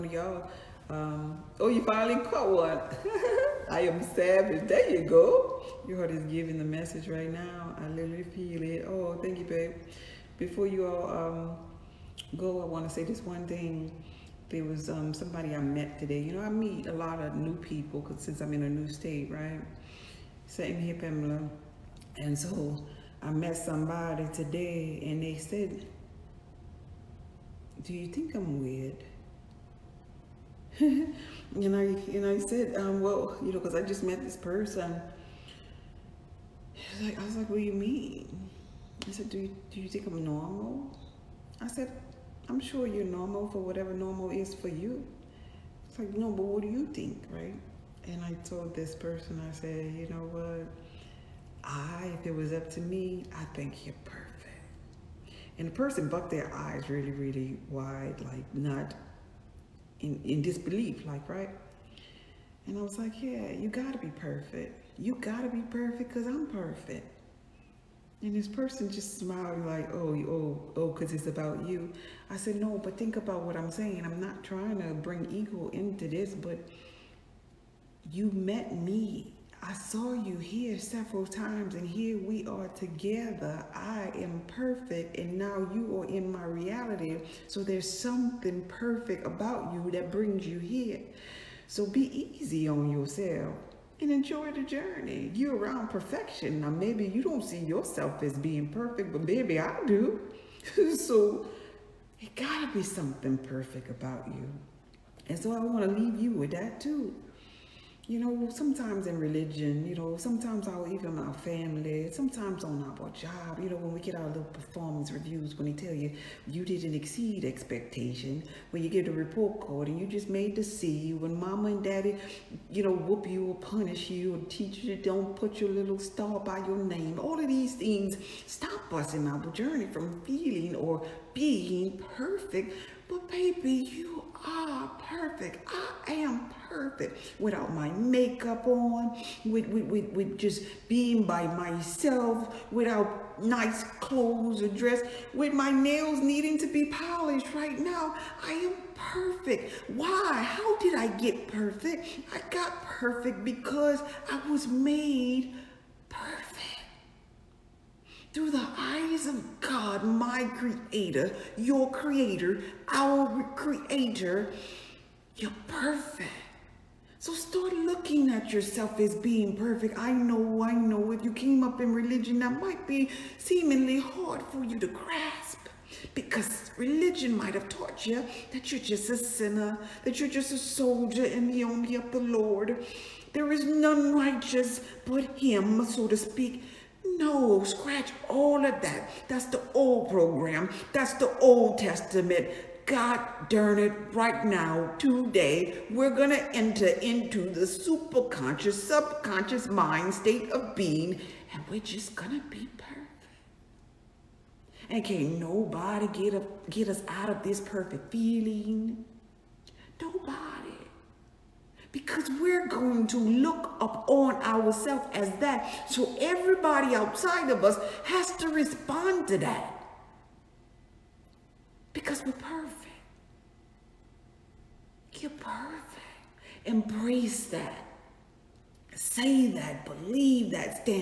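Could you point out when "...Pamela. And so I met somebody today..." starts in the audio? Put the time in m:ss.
0:20.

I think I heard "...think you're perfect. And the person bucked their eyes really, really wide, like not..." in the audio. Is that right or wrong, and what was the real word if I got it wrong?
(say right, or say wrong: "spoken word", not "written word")
right.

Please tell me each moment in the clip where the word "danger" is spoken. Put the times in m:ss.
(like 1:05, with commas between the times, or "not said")
not said.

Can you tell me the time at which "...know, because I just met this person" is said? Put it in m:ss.
0:33.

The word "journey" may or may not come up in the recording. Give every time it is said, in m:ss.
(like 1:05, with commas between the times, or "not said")
1:34, 2:09.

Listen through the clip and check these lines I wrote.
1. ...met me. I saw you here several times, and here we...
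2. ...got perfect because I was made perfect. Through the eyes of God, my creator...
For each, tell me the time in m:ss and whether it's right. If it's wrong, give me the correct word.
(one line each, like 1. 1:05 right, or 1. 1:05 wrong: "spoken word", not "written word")
1. 1:18 right
2. 2:32 right.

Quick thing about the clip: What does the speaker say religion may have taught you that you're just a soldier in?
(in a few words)
the army of the Lord.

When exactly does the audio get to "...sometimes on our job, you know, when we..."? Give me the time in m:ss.
1:52.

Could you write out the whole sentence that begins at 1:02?
And I was like, yeah, you gotta be perfect.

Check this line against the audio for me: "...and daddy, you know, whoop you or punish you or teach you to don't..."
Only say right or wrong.
right.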